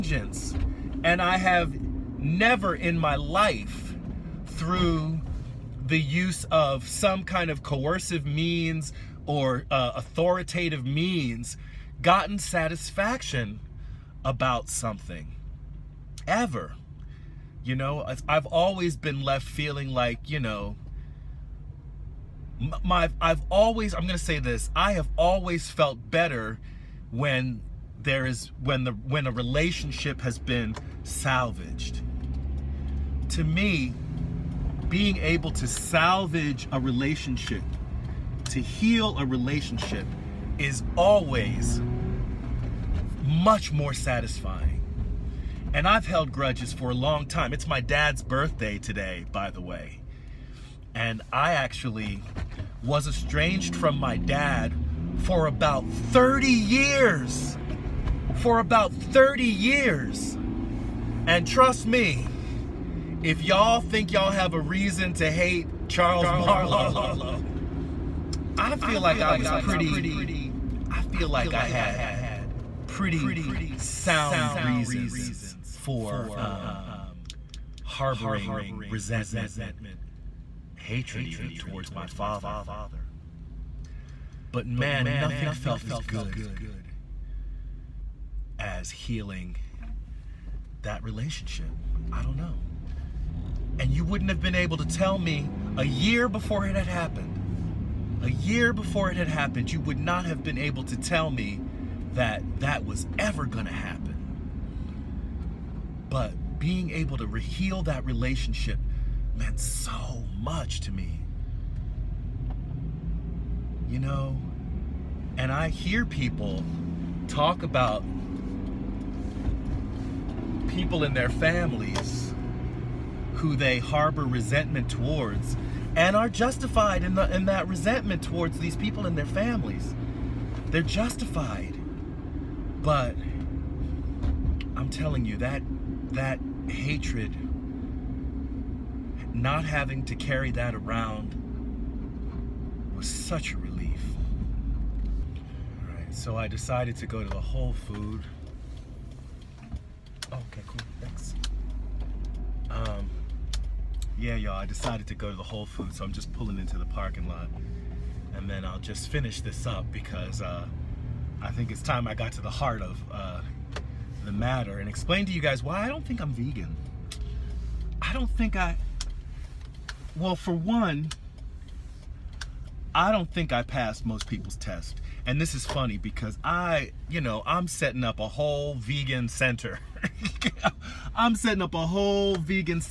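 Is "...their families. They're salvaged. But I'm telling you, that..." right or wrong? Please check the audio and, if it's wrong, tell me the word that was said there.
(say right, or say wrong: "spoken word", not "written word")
wrong: "justified", not "salvaged".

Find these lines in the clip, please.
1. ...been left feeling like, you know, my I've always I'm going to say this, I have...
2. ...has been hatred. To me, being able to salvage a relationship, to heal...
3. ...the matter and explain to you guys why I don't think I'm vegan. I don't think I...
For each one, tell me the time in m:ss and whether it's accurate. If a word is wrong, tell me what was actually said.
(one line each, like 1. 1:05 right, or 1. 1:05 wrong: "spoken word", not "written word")
1. 0:18 right
2. 0:30 wrong: "salvaged", not "hatred"
3. 2:44 right.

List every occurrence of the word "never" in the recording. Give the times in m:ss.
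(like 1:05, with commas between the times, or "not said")
0:02.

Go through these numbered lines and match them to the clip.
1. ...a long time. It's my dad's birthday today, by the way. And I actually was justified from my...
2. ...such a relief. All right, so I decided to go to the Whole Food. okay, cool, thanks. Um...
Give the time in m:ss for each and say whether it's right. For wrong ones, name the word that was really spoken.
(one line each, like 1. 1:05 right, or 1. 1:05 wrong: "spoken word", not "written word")
1. 0:46 wrong: "estranged", not "justified"
2. 2:23 right.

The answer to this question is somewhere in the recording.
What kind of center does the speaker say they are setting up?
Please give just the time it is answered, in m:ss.
2:58.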